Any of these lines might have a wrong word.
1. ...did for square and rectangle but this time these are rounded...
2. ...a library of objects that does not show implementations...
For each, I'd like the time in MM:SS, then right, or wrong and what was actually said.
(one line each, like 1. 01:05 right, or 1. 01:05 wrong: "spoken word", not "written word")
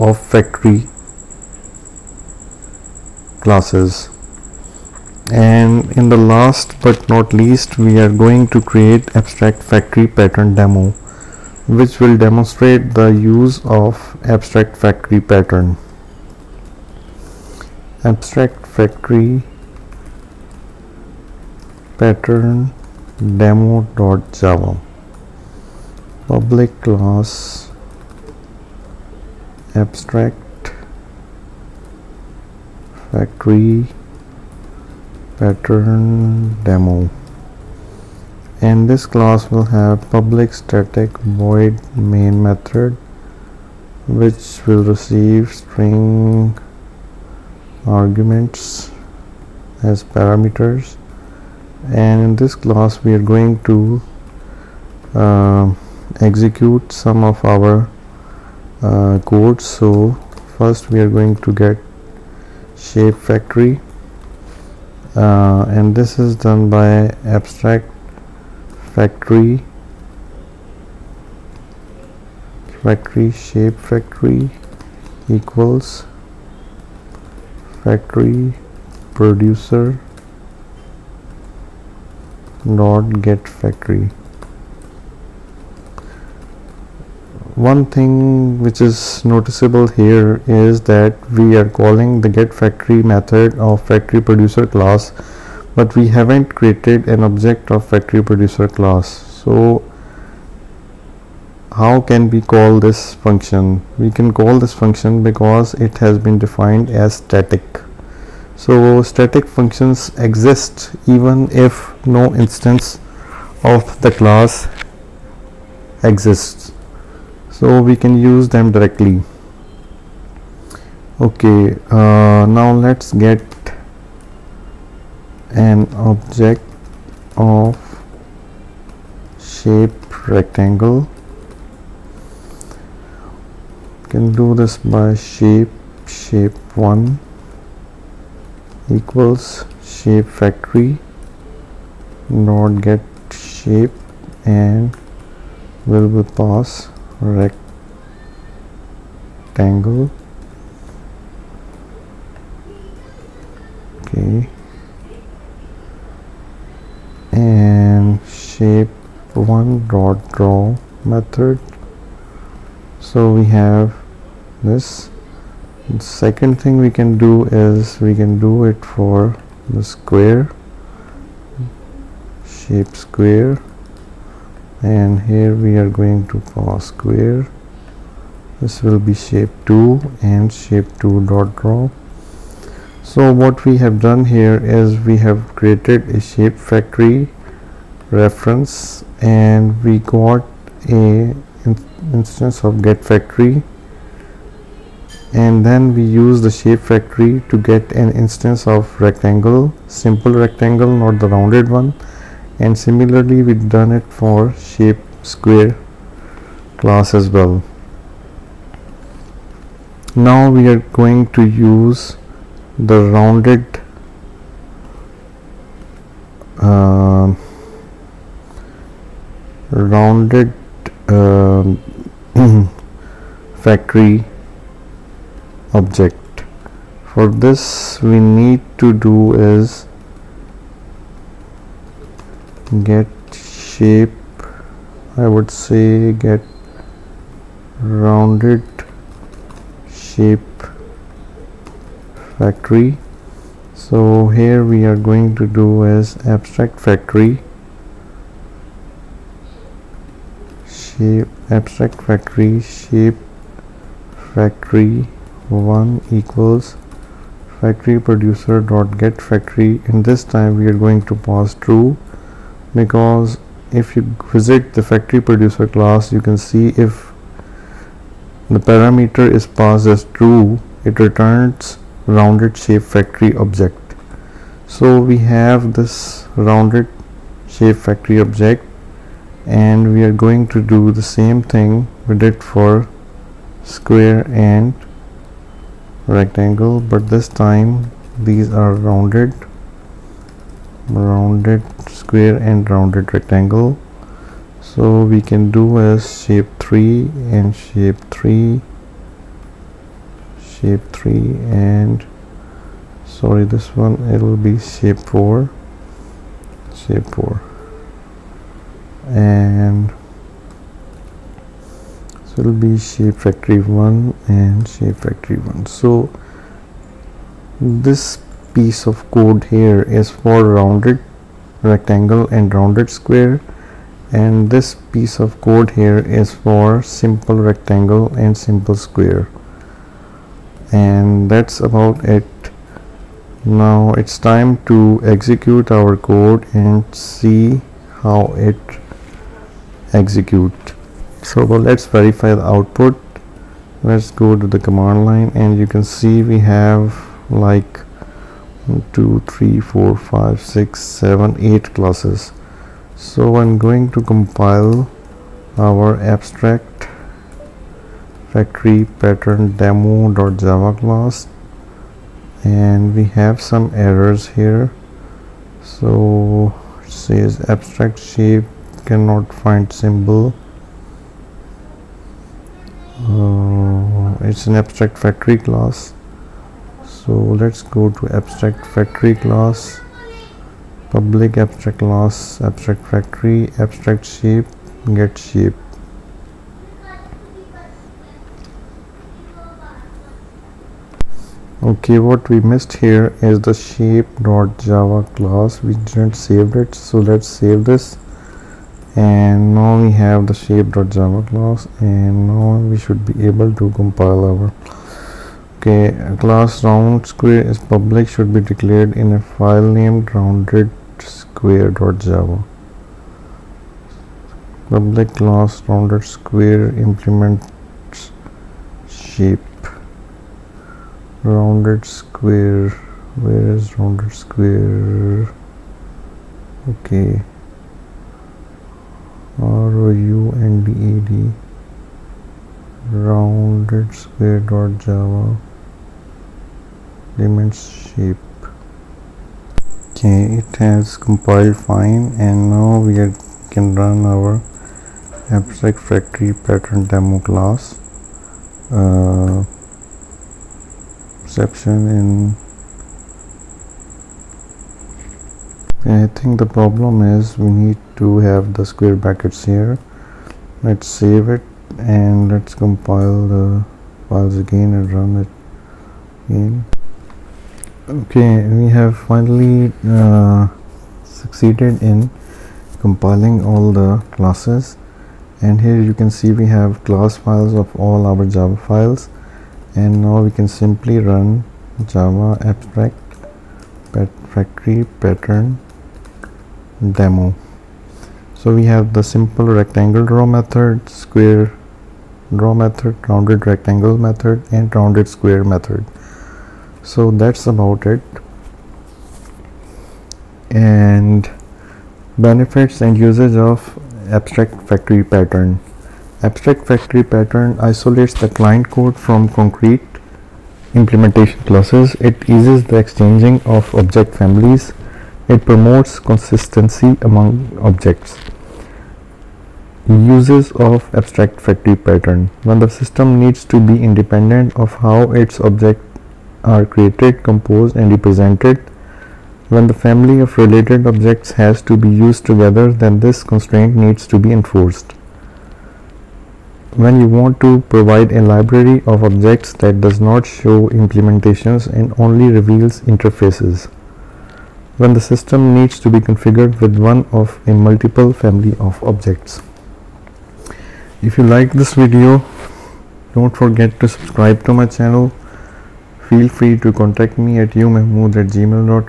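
1. 04:42 right
2. 08:58 right.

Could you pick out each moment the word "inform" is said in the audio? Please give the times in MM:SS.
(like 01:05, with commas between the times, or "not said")
not said.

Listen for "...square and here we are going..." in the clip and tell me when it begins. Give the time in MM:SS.
02:52.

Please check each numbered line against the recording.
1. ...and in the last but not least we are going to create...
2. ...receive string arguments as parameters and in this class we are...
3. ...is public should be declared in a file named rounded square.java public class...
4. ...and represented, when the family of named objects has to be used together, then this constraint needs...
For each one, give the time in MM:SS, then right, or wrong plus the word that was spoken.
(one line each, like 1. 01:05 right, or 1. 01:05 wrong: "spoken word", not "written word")
1. 00:05 right
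2. 00:44 right
3. 06:47 right
4. 08:47 wrong: "related", not "named".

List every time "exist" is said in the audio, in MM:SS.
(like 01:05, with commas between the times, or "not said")
01:50, 01:56.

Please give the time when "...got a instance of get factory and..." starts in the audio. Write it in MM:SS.
03:09.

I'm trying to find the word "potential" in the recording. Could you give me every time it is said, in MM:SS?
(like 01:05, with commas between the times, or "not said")
not said.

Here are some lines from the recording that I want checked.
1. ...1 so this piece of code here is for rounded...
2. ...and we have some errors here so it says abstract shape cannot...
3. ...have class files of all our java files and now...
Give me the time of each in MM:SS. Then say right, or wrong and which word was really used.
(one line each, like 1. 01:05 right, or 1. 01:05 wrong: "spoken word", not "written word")
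1. 05:15 right
2. 06:02 right
3. 07:56 right.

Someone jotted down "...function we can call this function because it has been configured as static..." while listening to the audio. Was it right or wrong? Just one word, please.
wrong.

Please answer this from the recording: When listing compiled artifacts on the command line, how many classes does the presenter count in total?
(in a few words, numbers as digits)
8.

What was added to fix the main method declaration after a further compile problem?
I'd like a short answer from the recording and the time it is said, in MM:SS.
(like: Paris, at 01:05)
square brackets, at 07:37.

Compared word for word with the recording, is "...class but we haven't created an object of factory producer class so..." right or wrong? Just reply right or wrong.
right.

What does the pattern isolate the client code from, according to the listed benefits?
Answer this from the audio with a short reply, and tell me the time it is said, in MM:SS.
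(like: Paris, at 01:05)
concrete implementation classes, at 08:29.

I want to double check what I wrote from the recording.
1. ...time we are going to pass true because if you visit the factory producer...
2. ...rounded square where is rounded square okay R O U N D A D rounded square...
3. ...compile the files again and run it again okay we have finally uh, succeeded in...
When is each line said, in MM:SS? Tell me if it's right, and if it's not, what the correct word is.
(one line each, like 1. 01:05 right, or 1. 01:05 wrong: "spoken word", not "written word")
1. 04:20 right
2. 07:01 right
3. 07:42 right.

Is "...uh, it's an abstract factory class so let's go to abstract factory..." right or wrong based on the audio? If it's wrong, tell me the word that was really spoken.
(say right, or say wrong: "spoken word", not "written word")
right.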